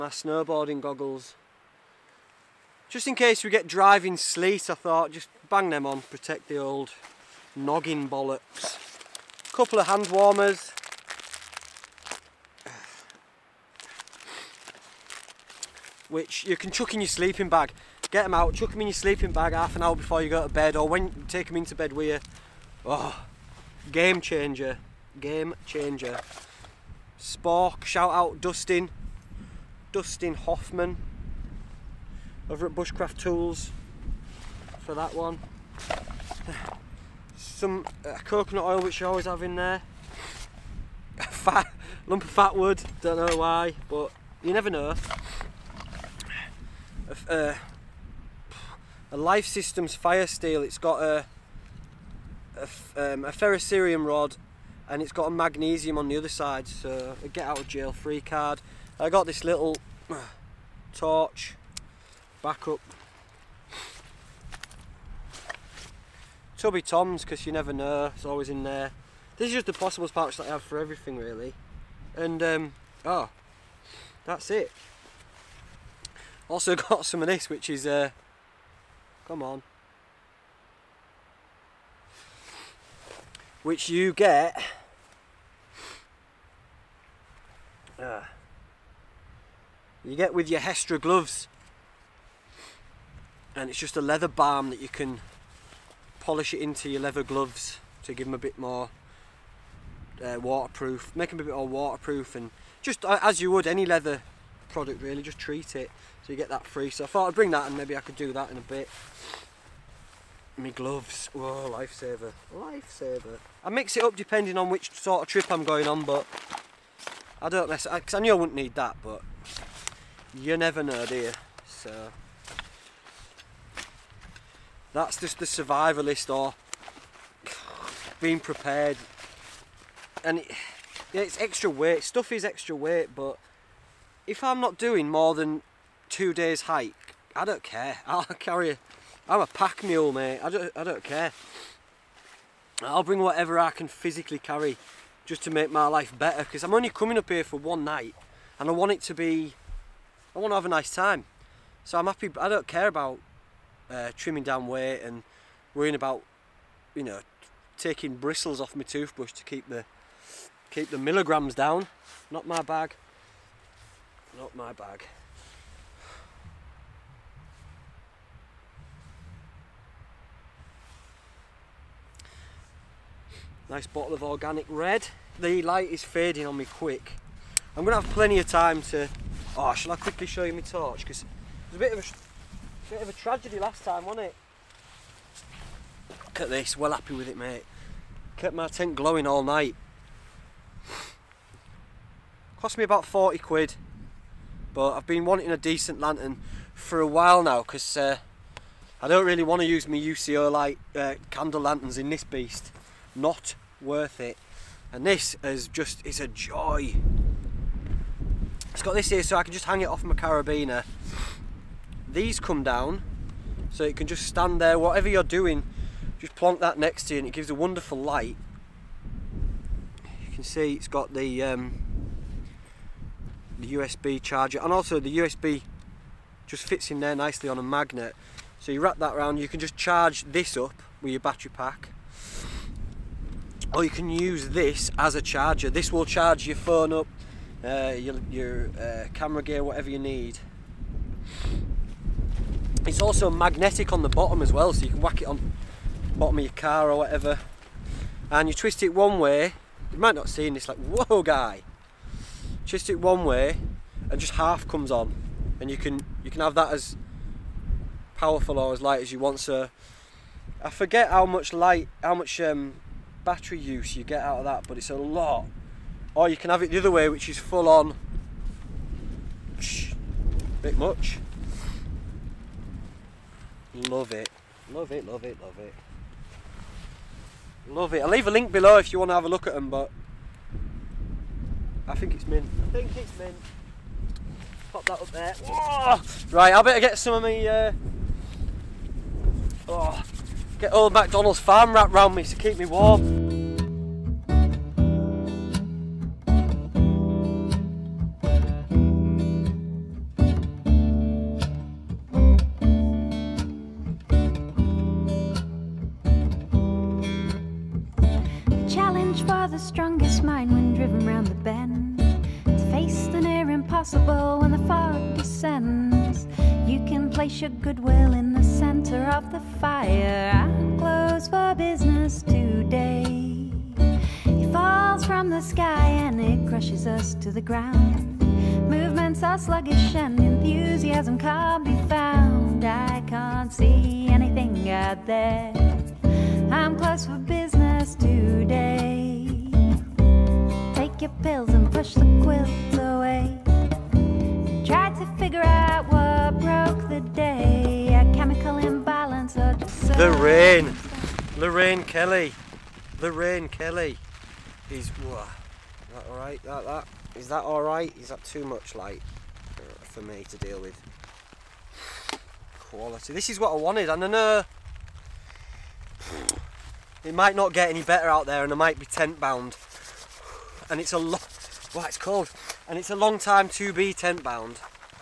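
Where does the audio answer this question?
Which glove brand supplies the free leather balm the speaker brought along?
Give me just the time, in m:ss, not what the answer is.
1:30.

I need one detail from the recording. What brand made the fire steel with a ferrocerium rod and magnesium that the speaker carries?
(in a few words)
Lifesystems.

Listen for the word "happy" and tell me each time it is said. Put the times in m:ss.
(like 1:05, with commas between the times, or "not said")
2:32, 3:06.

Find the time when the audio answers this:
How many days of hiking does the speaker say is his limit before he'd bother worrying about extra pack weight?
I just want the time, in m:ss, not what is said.
2:16.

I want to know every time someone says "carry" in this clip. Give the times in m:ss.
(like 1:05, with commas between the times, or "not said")
2:18, 2:24.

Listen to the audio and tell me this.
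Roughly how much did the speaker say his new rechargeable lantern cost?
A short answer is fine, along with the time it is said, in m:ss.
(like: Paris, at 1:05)
40 quid, at 3:13.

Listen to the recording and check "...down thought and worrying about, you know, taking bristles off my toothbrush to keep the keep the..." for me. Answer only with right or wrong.
wrong.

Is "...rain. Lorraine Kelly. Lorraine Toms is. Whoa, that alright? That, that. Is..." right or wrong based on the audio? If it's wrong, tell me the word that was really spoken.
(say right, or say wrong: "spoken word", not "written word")
wrong: "Kelly", not "Toms".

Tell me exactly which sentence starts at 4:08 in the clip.
And you twist it one way, you might not see in this like, whoa guy.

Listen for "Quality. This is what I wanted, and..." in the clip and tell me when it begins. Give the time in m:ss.
6:02.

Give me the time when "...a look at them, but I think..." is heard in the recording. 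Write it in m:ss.
4:39.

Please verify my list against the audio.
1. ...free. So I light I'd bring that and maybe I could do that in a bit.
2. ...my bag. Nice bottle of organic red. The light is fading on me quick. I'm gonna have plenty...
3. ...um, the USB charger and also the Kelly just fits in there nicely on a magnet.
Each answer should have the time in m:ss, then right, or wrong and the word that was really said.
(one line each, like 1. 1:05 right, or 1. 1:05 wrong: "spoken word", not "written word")
1. 1:46 wrong: "thought", not "light"
2. 2:44 right
3. 3:41 wrong: "USB", not "Kelly".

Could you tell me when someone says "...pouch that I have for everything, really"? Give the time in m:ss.
1:10.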